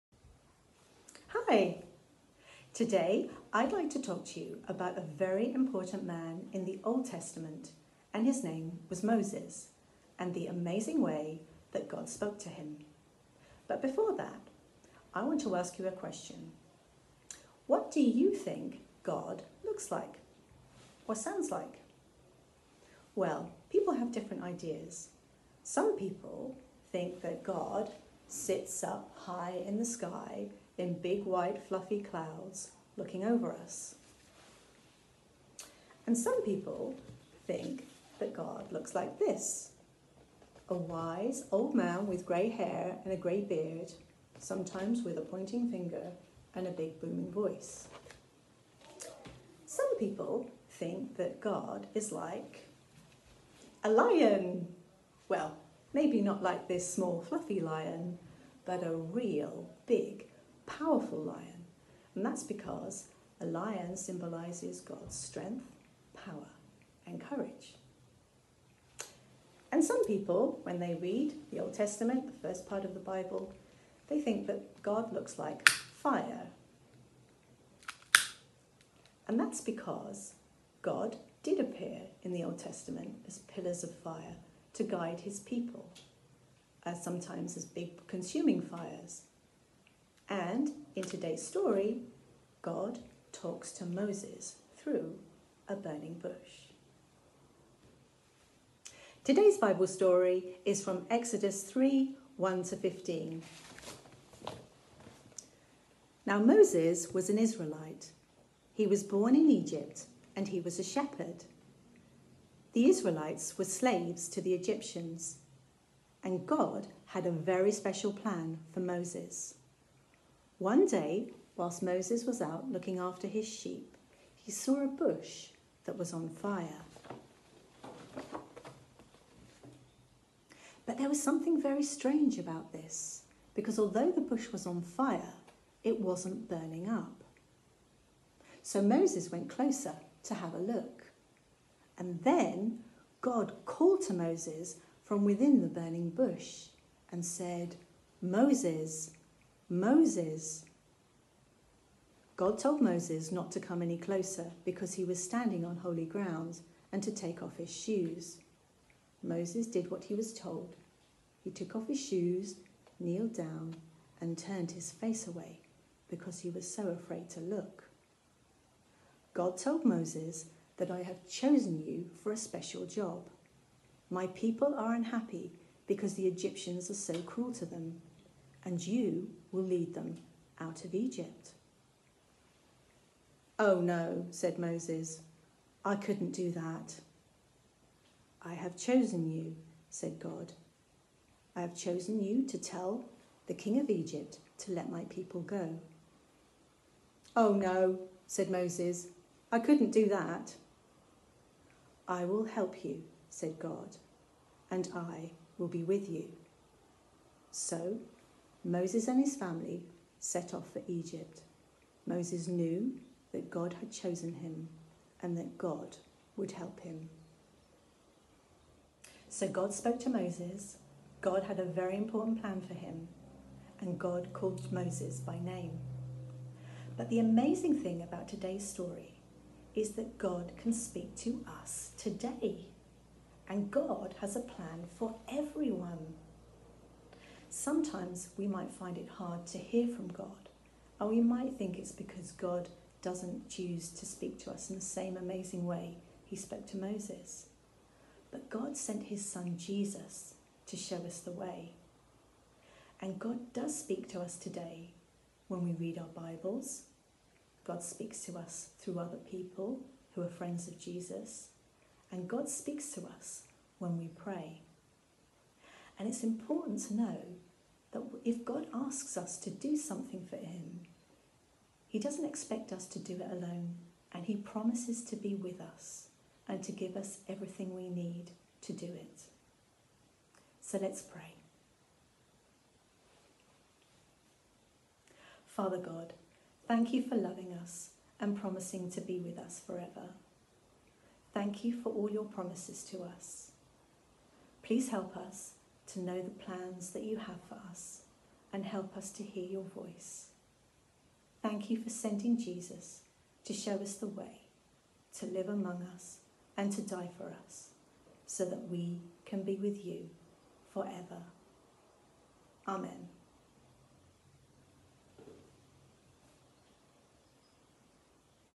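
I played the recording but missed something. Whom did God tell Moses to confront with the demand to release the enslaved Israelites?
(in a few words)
The king of Egypt.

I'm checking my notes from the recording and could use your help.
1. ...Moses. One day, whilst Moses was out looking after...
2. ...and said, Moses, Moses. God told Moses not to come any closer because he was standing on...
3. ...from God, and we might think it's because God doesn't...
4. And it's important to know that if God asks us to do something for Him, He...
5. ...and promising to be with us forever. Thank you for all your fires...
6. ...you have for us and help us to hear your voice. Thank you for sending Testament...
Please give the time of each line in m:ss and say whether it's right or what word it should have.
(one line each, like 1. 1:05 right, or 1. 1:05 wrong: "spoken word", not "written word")
1. 1:58 right
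2. 2:27 right
3. 3:59 right
4. 4:25 right
5. 4:48 wrong: "promises", not "fires"
6. 4:57 wrong: "Jesus", not "Testament".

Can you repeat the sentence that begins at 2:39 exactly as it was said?
Moses did what he was told.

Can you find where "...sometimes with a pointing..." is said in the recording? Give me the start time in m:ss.
0:44.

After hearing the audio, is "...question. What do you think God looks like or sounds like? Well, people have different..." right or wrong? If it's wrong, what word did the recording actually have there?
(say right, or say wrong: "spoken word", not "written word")
right.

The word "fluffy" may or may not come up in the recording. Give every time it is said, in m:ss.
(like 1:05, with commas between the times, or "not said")
0:31, 0:57.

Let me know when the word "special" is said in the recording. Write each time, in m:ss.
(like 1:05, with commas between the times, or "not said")
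1:57, 2:52.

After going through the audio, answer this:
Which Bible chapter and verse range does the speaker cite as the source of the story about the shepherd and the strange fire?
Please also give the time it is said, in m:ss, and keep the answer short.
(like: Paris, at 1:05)
Exodus 3:1-15, at 1:41.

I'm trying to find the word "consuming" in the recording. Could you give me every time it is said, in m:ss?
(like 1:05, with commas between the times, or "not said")
1:28.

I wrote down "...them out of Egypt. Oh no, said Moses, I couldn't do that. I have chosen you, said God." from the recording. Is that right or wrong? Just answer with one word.
right.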